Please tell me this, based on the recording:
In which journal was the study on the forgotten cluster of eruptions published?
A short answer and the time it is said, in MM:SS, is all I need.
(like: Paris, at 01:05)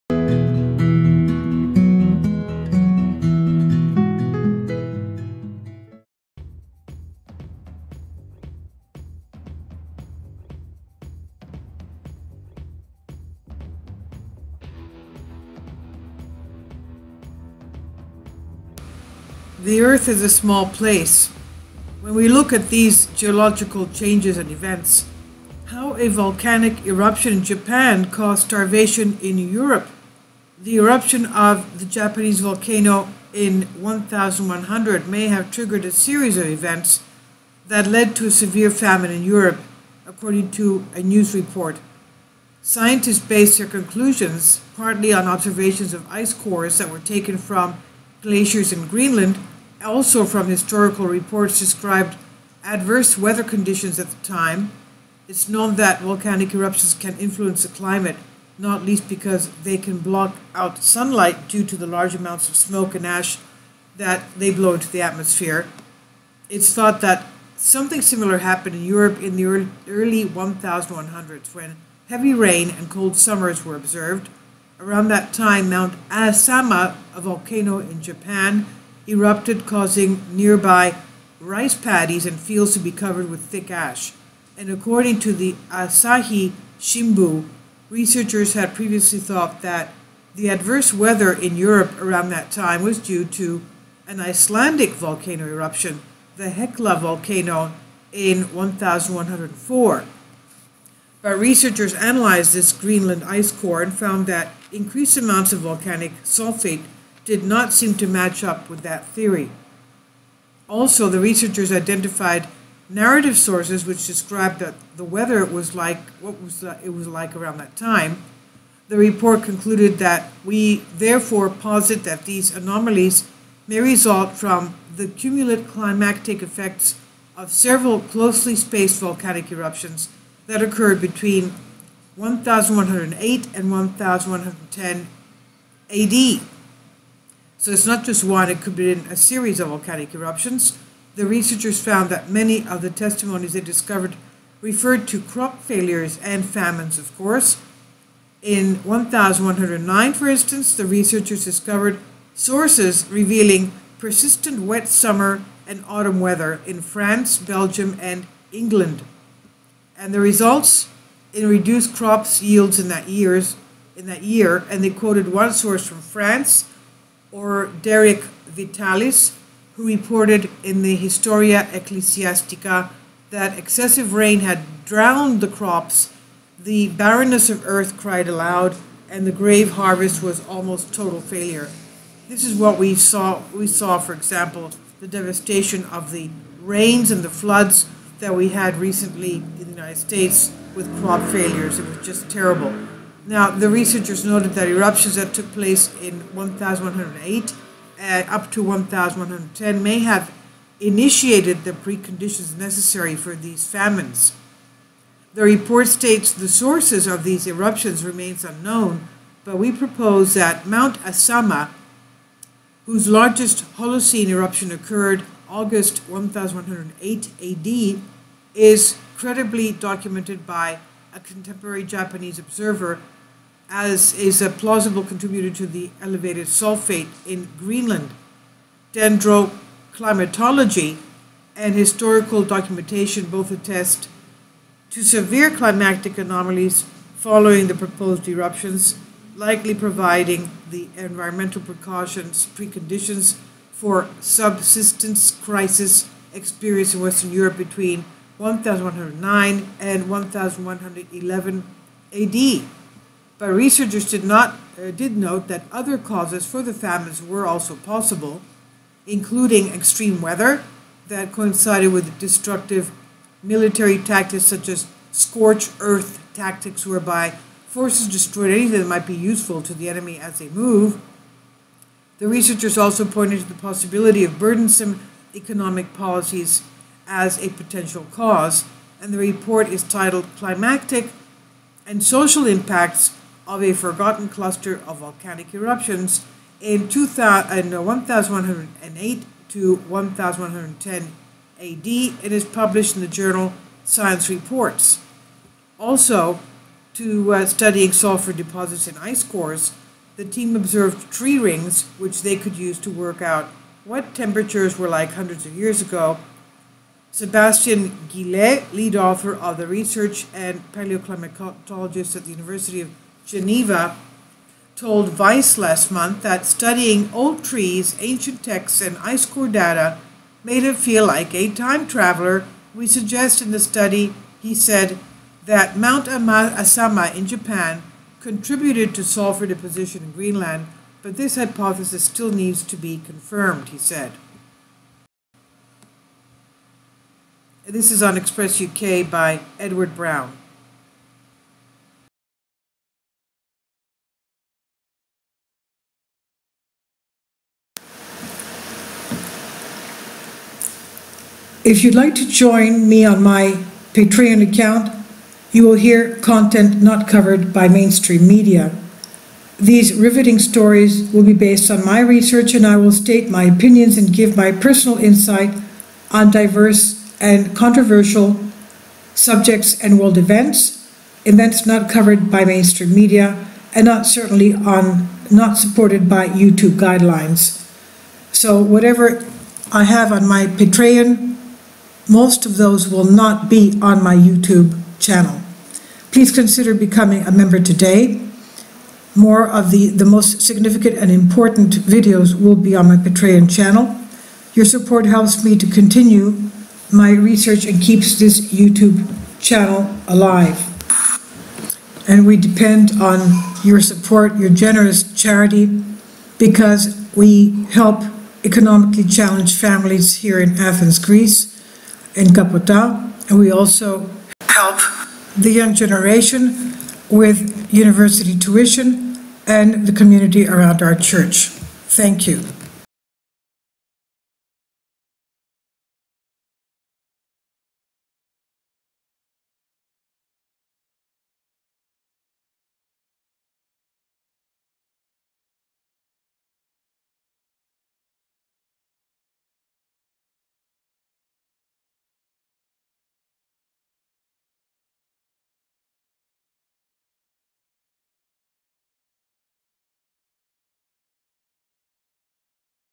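Science Reports, at 04:53.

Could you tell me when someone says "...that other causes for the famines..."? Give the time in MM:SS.
04:15.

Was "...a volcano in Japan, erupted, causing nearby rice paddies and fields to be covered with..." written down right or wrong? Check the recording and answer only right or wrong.
right.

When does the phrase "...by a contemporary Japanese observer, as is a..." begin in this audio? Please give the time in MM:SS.
03:40.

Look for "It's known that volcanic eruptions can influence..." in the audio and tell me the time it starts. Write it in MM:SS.
00:55.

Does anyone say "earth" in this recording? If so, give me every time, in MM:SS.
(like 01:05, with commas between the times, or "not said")
00:19, 02:57, 04:25.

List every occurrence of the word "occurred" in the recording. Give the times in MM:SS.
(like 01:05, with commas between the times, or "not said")
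02:10, 03:34.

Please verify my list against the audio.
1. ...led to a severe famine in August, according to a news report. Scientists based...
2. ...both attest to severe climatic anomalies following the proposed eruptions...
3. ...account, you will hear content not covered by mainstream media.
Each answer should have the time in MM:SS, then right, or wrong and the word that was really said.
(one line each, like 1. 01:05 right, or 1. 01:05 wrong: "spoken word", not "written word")
1. 00:37 wrong: "Europe", not "August"
2. 03:53 right
3. 05:54 right.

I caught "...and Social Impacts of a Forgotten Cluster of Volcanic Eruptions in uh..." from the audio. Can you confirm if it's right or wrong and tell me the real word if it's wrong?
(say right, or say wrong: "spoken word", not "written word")
right.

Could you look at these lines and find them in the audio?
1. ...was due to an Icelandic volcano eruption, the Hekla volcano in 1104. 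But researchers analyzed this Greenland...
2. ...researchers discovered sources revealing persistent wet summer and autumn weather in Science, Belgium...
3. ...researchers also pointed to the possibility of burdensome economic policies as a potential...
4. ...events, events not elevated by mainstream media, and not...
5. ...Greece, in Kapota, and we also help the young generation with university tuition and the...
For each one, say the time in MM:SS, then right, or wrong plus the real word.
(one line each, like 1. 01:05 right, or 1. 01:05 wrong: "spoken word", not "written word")
1. 01:32 right
2. 02:30 wrong: "France", not "Science"
3. 04:32 right
4. 06:10 wrong: "covered", not "elevated"
5. 06:50 right.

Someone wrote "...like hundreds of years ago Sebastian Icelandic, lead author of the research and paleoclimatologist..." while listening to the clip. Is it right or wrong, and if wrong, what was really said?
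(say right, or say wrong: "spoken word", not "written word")
wrong: "Guillet", not "Icelandic".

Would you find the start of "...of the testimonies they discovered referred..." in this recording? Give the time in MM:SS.
02:22.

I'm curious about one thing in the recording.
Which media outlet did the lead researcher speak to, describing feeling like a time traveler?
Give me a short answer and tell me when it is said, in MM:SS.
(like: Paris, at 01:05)
Vice, at 05:15.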